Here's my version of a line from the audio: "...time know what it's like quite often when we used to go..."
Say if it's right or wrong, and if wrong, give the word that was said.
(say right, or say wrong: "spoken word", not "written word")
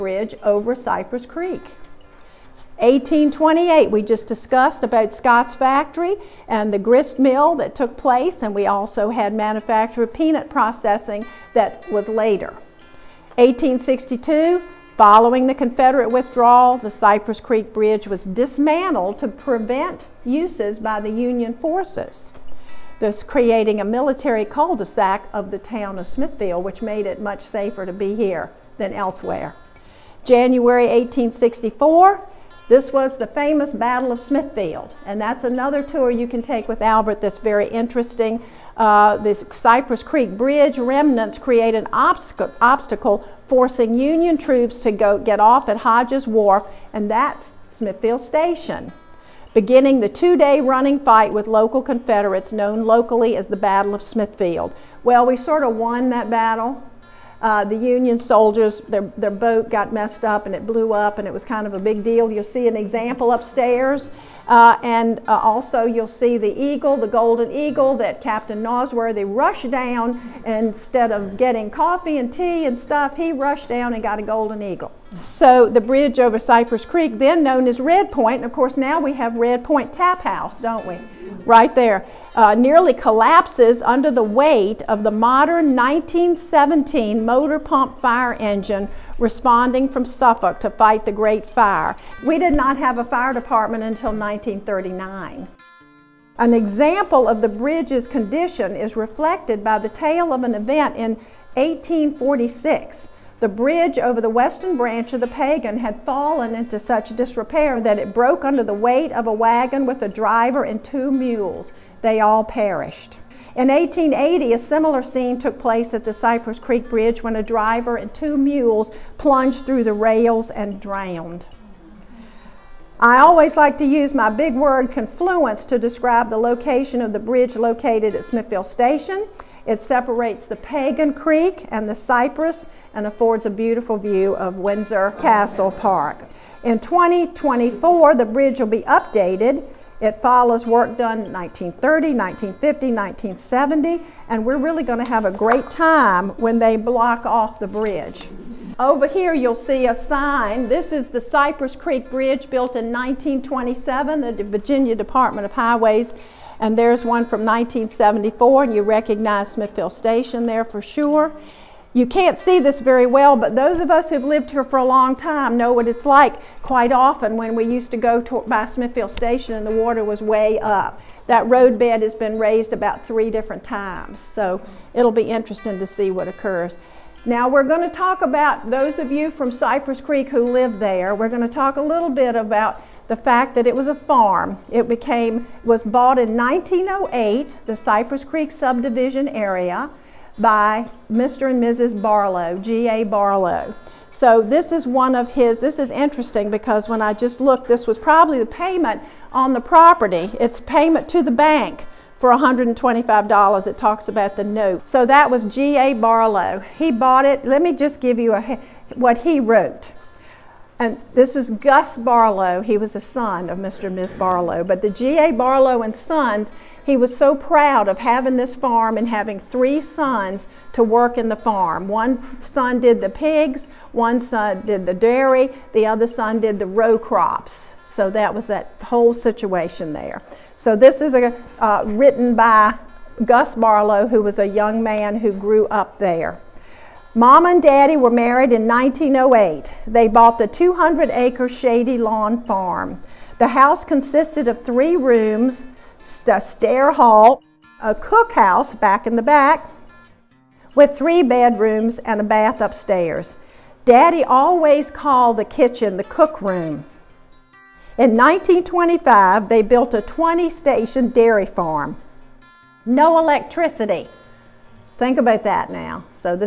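right.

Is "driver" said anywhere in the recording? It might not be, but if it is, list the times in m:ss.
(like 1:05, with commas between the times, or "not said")
1:50, 1:57.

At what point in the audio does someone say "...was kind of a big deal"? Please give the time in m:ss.
1:01.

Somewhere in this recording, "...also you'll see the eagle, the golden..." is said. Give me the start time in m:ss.
1:05.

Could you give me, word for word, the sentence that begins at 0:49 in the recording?
Beginning the two day running fight with local Confederates known locally as the Battle of Smithfield.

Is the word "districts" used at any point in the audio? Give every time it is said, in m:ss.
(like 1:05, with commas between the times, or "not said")
not said.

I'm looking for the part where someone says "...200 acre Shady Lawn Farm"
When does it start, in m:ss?
4:00.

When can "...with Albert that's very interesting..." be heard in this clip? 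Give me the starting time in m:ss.
0:36.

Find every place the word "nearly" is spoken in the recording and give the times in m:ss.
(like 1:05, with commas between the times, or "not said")
1:22.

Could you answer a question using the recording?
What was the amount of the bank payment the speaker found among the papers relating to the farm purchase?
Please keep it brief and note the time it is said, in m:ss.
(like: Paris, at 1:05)
$125, at 3:22.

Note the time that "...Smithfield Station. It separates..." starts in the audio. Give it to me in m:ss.
2:08.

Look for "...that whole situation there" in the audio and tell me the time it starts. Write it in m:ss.
3:48.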